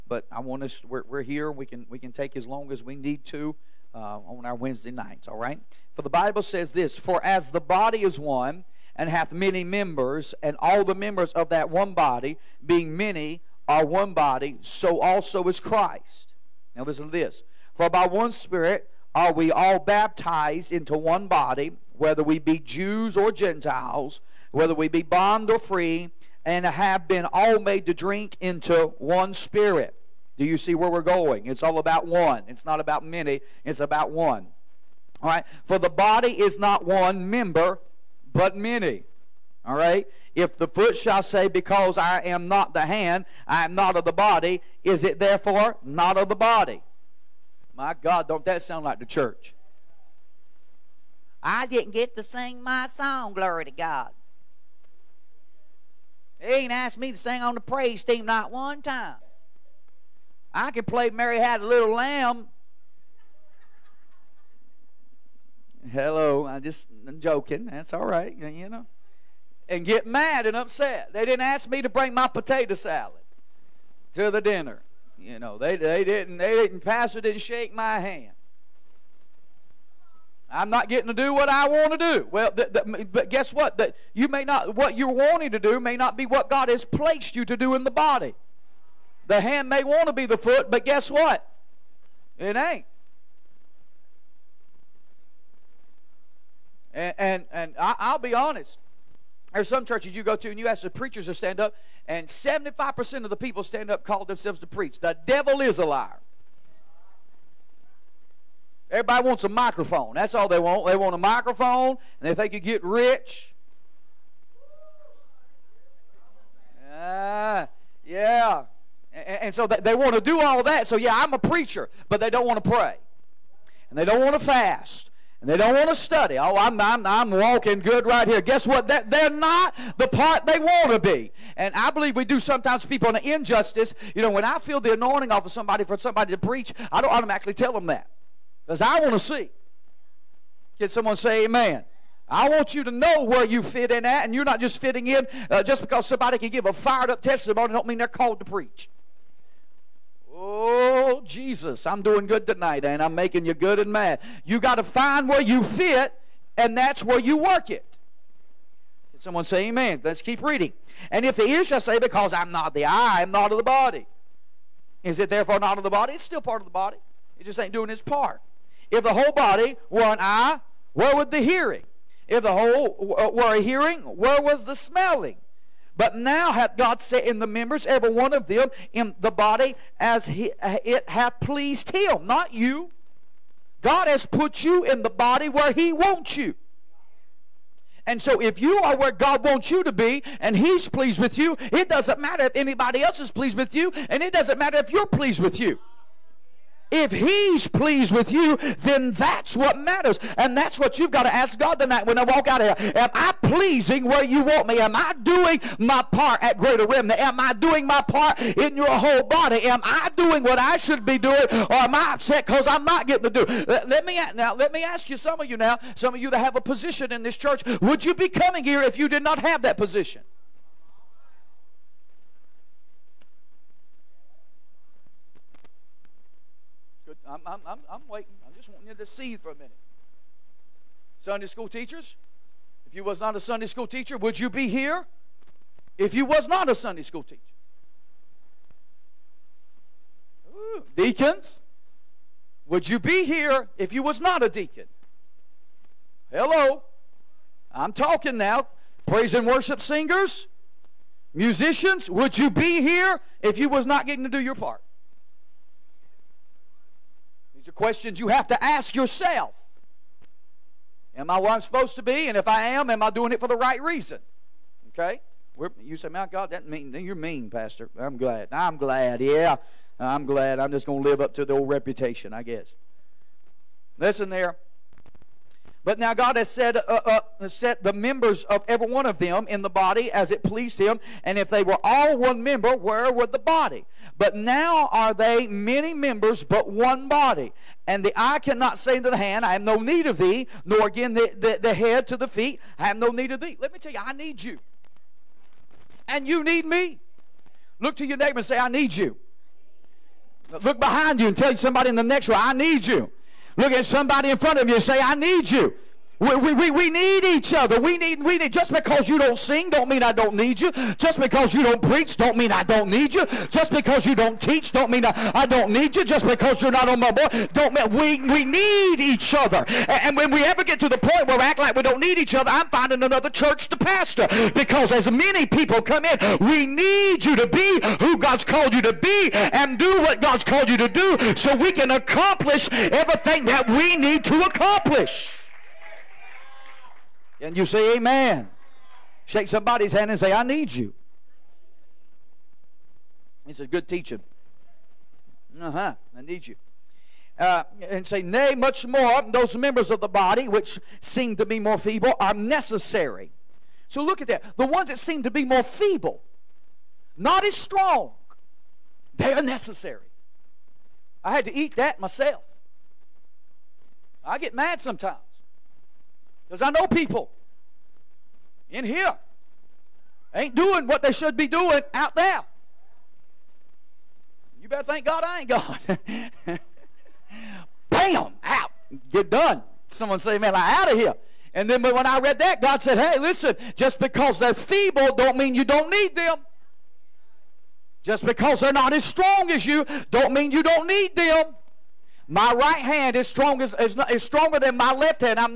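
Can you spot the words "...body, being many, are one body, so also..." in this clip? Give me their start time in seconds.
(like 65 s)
11 s.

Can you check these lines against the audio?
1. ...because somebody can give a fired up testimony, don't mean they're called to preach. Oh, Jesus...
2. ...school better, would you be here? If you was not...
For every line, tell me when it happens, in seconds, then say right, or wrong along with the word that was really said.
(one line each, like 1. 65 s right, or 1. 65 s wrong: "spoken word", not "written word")
1. 145 s right
2. 233 s wrong: "teacher", not "better".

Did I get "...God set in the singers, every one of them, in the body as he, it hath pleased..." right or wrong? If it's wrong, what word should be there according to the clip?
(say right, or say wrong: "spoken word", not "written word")
wrong: "members", not "singers".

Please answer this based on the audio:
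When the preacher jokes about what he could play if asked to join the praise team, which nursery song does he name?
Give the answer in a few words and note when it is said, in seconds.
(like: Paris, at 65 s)
Mary Had a Little Lamb, at 61 s.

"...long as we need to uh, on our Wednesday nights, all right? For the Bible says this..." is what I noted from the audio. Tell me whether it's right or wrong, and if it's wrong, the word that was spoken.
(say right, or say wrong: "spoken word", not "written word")
right.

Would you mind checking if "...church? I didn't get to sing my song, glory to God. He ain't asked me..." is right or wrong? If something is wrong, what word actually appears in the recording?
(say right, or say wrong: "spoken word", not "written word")
right.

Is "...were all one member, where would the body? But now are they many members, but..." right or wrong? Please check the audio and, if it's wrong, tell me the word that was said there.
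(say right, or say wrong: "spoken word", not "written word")
right.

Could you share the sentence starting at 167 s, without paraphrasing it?
It just ain't doing its part.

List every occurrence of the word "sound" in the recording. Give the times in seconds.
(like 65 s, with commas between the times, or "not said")
48 s.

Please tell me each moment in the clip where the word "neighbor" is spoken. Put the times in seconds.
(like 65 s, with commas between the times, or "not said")
298 s.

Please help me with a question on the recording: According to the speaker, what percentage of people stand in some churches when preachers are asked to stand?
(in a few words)
75%.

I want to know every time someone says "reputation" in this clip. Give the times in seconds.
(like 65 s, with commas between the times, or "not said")
271 s.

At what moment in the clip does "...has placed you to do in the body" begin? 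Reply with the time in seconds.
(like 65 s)
86 s.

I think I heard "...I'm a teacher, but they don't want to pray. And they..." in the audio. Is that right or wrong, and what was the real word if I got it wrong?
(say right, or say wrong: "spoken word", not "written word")
wrong: "preacher", not "teacher".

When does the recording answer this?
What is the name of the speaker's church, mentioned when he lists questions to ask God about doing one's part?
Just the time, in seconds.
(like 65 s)
206 s.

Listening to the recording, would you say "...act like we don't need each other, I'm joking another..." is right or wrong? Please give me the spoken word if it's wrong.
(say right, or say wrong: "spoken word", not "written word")
wrong: "finding", not "joking".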